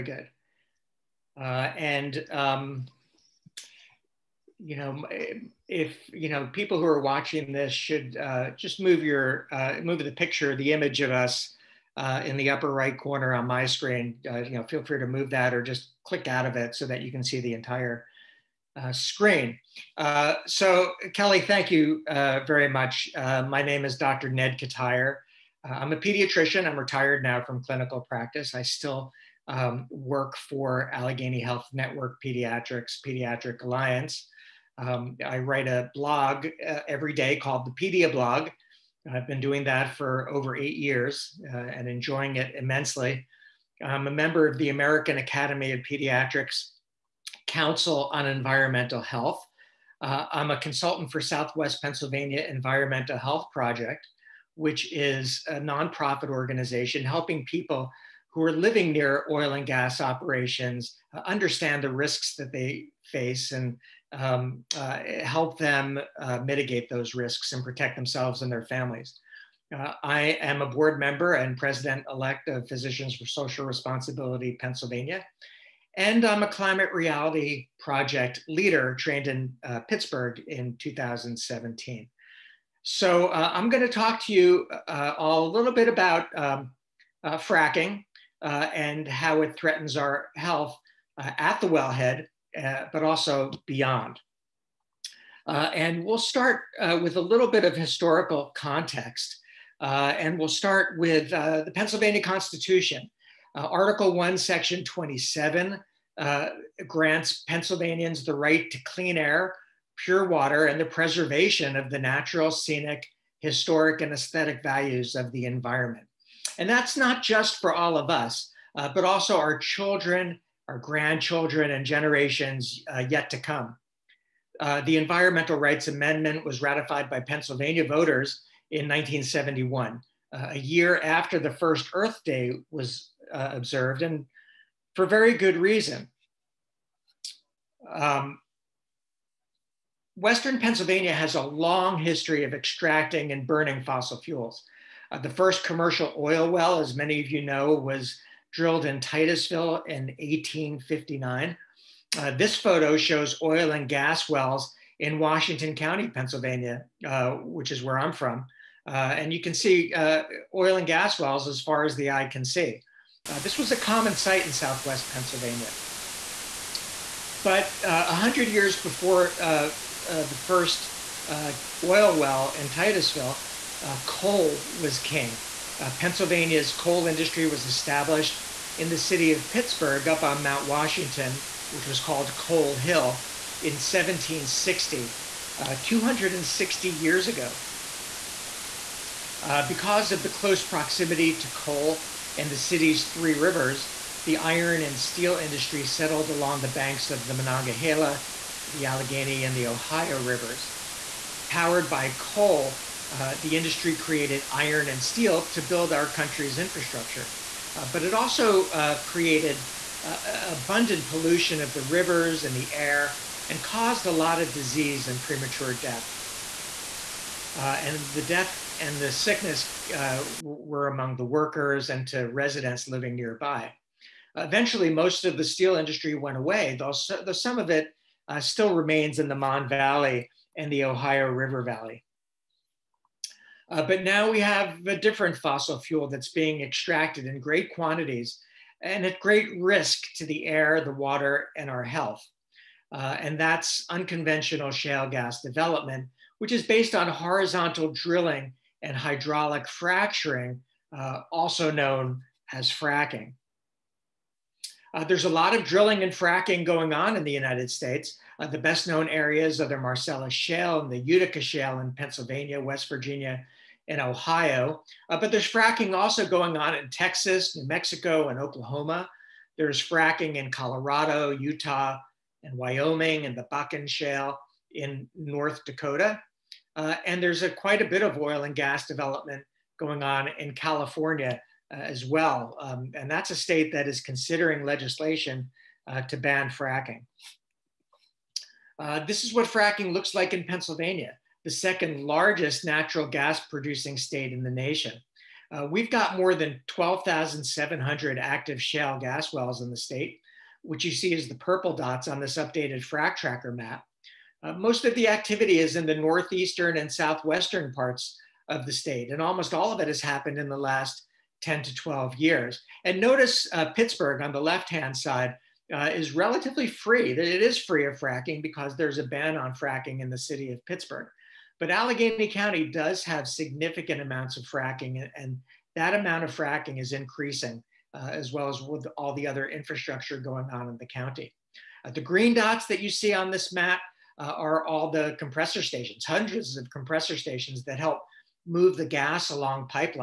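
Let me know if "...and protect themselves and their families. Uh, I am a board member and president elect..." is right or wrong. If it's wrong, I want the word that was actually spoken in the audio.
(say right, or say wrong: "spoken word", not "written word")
right.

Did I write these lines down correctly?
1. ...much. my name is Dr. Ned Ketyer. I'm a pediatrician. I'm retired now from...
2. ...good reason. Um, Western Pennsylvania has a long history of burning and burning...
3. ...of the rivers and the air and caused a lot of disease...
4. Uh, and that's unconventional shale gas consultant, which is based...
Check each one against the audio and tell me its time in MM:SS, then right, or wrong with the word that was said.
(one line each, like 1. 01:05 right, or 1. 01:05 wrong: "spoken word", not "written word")
1. 00:22 right
2. 02:15 wrong: "extracting", not "burning"
3. 03:31 right
4. 04:02 wrong: "development", not "consultant".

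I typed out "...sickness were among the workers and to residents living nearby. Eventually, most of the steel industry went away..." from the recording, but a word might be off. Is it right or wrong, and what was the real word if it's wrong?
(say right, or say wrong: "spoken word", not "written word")
right.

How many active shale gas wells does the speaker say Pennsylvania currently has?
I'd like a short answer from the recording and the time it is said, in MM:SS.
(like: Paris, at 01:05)
more than 12,700, at 04:56.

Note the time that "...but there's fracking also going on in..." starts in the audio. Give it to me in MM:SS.
04:25.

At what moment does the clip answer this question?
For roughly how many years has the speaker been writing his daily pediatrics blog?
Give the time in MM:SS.
00:40.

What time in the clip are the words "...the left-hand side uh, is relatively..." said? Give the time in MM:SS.
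05:14.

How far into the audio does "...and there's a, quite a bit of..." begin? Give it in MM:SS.
04:37.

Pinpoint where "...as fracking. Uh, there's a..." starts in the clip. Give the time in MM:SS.
04:12.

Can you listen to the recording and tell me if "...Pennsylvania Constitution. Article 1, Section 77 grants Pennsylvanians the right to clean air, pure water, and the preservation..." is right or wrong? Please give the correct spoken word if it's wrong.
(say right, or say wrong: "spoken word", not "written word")
wrong: "27", not "77".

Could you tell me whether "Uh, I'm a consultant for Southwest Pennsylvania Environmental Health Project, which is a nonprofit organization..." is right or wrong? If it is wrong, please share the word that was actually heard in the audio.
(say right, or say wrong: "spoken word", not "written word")
right.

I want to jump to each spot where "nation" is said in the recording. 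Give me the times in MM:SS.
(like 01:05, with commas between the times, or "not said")
04:54.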